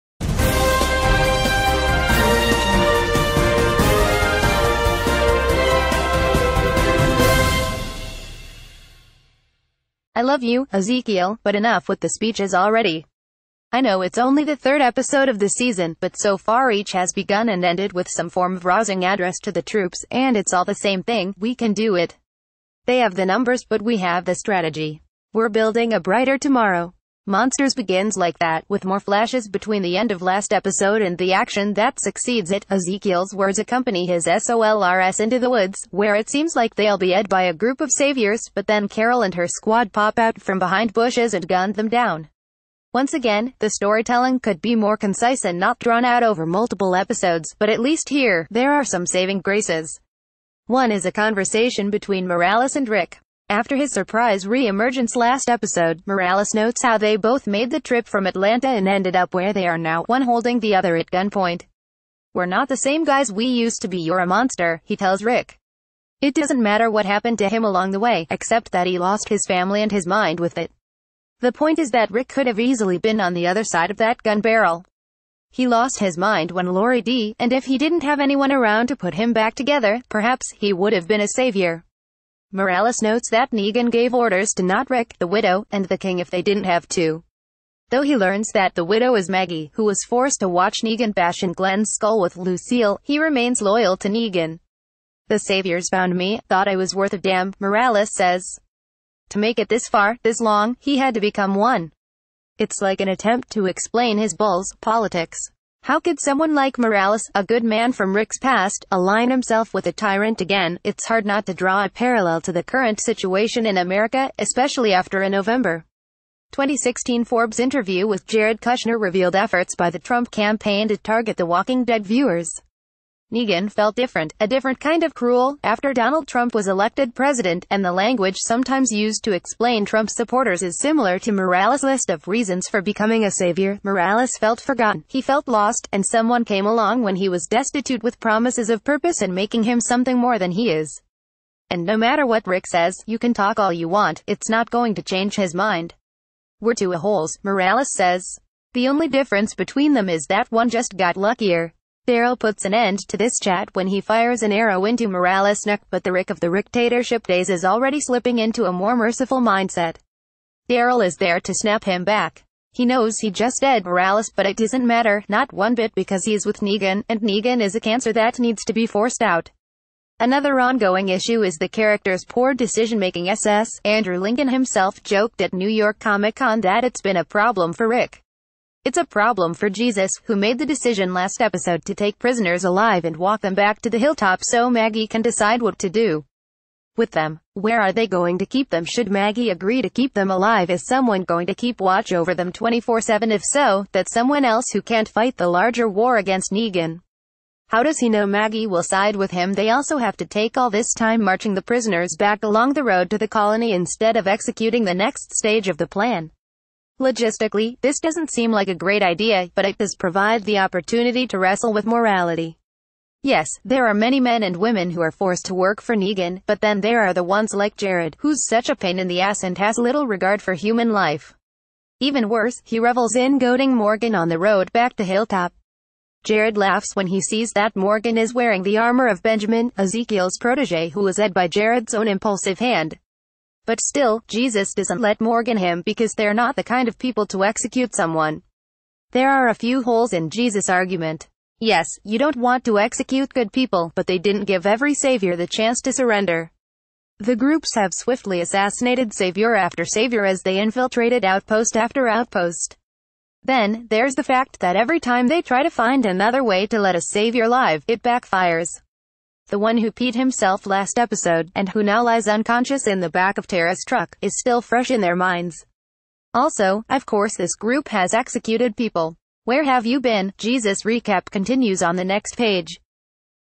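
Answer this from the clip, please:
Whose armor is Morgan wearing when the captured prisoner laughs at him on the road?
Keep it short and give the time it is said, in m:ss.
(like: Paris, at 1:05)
Benjamin, at 3:49.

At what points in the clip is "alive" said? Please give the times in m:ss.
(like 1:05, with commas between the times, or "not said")
3:02, 3:10.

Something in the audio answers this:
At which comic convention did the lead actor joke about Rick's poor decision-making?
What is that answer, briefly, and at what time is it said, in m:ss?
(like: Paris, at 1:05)
New York Comic-Con, at 2:55.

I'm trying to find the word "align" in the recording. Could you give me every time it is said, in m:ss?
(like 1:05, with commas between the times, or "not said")
1:48.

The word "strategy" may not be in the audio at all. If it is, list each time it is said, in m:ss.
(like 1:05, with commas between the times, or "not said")
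0:24.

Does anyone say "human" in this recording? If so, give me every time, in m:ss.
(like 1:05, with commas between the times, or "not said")
3:40.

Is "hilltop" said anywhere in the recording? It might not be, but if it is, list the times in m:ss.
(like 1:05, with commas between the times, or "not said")
3:03, 3:45.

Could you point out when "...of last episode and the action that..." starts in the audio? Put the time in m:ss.
0:30.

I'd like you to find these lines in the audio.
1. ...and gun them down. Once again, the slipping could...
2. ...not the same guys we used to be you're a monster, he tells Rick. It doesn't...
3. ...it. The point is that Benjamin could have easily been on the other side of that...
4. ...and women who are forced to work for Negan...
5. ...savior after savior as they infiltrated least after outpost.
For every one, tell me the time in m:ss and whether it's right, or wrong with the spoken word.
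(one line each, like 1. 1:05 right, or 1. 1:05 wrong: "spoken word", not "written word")
1. 0:41 wrong: "storytelling", not "slipping"
2. 1:02 right
3. 1:10 wrong: "Rick", not "Benjamin"
4. 3:34 right
5. 4:09 wrong: "outpost", not "least".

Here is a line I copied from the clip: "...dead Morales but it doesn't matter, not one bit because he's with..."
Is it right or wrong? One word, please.
right.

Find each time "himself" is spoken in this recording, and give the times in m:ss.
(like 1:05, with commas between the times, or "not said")
1:49, 2:54, 4:20.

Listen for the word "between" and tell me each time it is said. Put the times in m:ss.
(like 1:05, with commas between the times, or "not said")
0:29, 0:51, 2:29.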